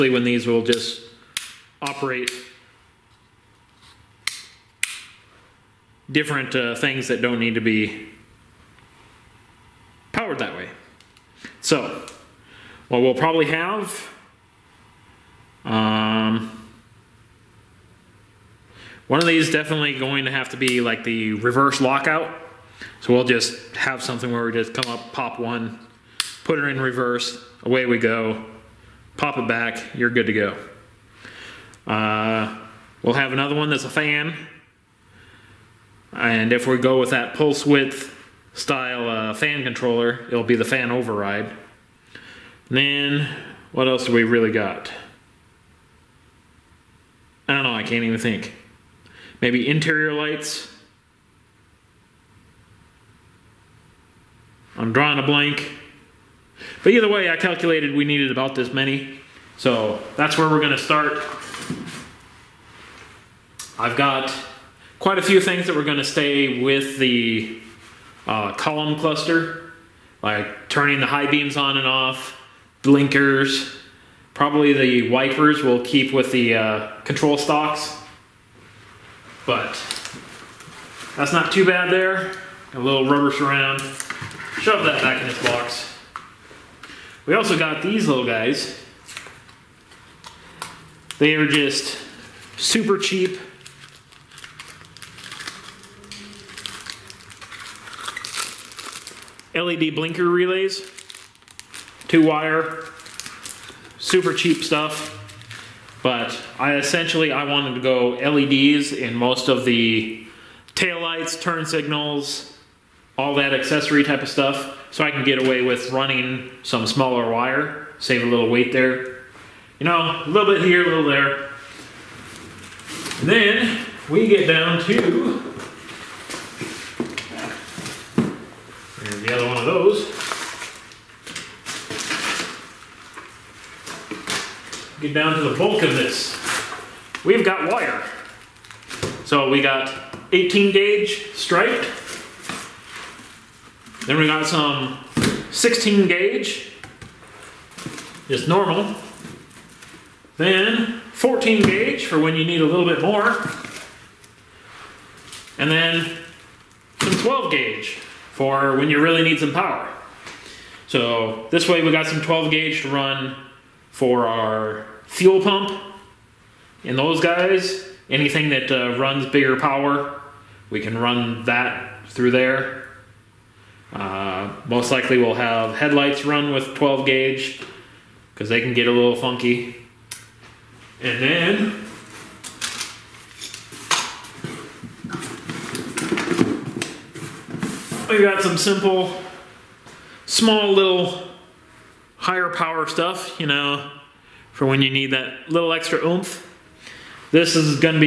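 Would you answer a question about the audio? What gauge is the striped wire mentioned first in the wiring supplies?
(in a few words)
18 gauge.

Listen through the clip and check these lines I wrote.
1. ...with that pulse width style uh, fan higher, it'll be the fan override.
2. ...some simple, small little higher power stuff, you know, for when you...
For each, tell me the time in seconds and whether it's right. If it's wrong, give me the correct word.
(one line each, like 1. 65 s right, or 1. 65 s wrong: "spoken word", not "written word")
1. 36 s wrong: "controller", not "higher"
2. 188 s right.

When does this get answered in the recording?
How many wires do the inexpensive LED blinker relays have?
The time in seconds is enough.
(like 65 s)
102 s.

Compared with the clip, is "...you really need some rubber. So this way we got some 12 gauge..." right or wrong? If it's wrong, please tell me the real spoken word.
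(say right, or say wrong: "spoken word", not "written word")
wrong: "power", not "rubber".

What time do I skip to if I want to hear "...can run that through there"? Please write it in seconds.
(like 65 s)
170 s.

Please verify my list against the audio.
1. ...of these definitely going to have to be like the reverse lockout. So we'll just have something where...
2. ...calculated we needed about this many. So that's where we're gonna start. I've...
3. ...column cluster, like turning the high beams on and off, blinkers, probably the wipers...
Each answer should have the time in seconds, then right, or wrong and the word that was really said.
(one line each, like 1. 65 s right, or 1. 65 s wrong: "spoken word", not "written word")
1. 19 s right
2. 57 s right
3. 68 s right.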